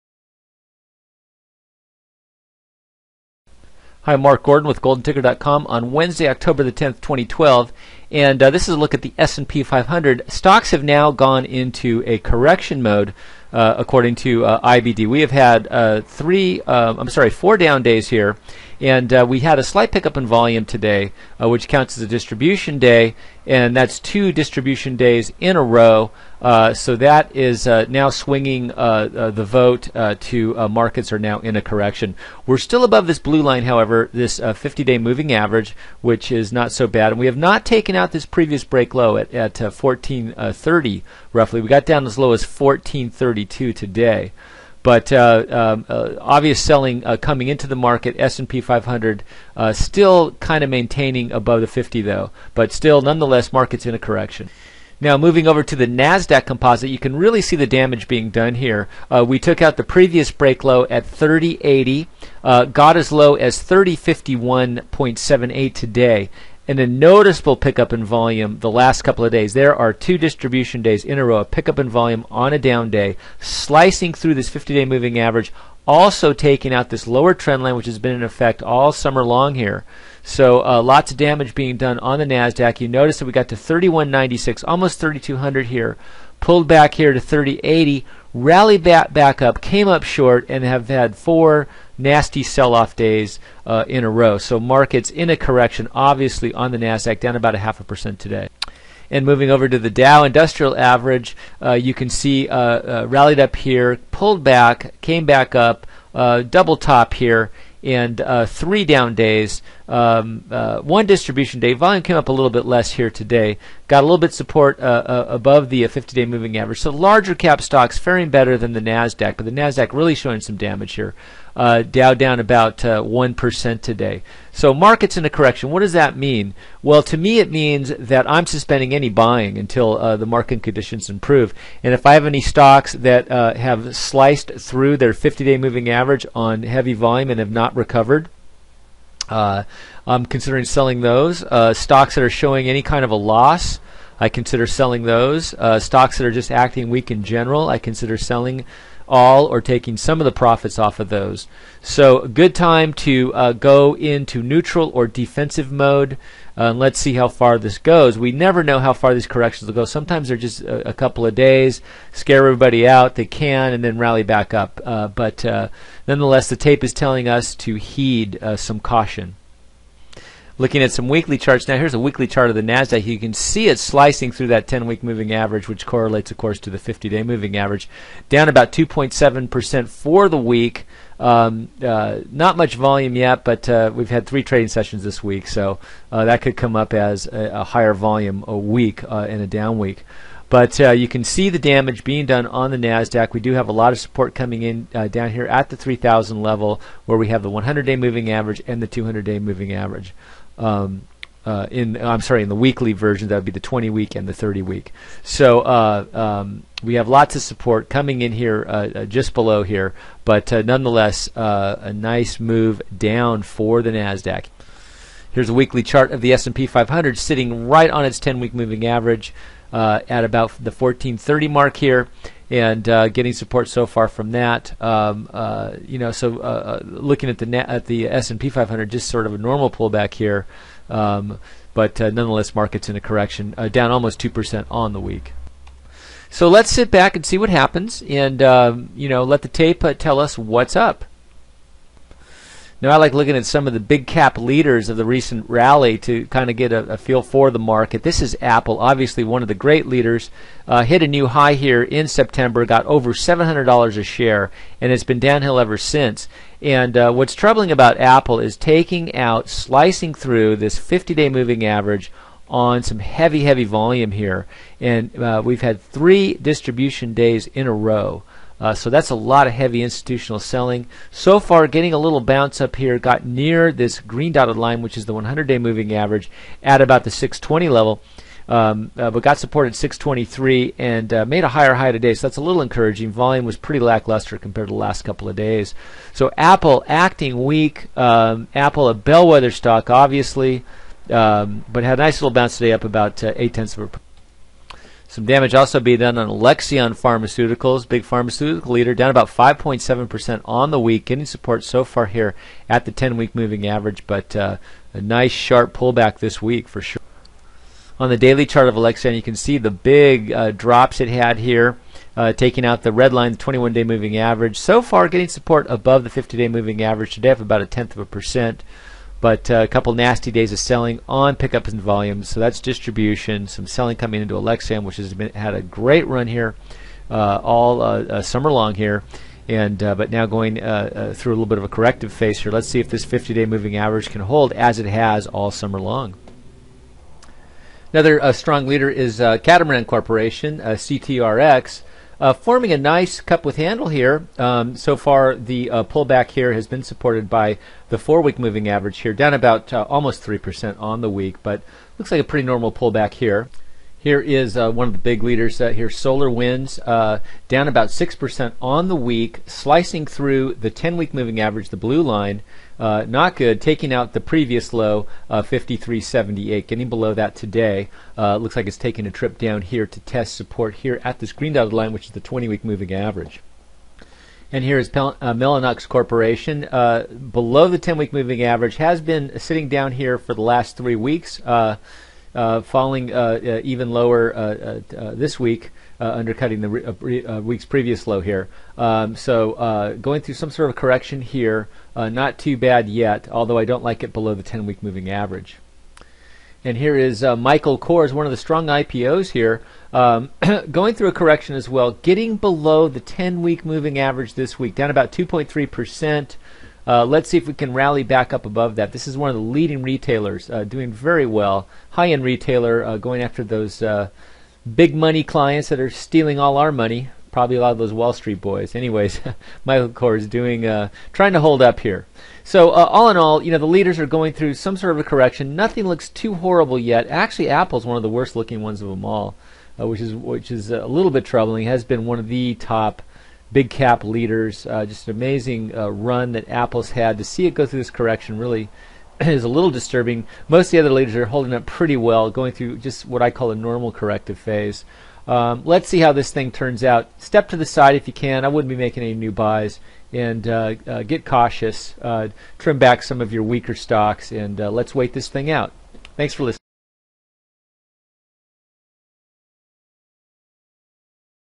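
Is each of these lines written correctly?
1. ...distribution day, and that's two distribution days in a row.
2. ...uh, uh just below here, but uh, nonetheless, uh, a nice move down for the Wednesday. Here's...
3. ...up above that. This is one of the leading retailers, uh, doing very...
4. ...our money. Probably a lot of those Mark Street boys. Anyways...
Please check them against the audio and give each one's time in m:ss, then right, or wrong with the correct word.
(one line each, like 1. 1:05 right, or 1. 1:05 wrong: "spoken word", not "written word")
1. 0:22 right
2. 3:28 wrong: "Nasdaq", not "Wednesday"
3. 6:48 right
4. 6:56 wrong: "Wall", not "Mark".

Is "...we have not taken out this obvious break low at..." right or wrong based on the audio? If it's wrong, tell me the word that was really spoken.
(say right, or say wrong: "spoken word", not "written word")
wrong: "previous", not "obvious".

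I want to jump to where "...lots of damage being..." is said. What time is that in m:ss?
1:20.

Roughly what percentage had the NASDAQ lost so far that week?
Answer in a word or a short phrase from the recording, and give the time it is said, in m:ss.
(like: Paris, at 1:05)
2.7%, at 2:58.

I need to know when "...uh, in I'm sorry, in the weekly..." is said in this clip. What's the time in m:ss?
3:21.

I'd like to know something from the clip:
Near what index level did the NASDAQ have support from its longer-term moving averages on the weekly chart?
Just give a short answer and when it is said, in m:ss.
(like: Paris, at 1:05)
3,000, at 3:15.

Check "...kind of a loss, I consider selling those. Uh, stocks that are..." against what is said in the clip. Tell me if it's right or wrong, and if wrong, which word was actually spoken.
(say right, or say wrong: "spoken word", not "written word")
right.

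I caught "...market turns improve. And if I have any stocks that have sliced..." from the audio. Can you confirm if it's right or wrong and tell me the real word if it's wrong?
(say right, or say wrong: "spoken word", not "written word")
wrong: "conditions", not "turns".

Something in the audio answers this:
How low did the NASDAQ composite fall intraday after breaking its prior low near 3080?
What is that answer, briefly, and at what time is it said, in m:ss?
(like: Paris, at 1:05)
3051.78, at 1:03.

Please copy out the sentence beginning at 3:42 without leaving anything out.
And uh, getting support so far from that, um, uh, you know.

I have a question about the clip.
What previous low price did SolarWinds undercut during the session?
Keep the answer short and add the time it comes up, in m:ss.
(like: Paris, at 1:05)
53.78, at 6:05.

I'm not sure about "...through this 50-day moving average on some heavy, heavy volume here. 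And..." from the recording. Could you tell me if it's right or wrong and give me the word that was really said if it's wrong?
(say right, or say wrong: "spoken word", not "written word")
right.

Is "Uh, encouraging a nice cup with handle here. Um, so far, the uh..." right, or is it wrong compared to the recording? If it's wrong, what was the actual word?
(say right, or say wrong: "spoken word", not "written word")
wrong: "forming", not "encouraging".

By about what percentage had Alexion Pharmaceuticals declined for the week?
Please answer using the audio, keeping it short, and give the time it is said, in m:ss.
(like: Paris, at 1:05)
5.7%, at 4:59.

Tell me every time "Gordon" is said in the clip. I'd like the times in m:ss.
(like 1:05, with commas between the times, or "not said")
0:04.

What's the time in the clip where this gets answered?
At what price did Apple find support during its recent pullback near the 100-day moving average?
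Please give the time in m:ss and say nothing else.
4:39.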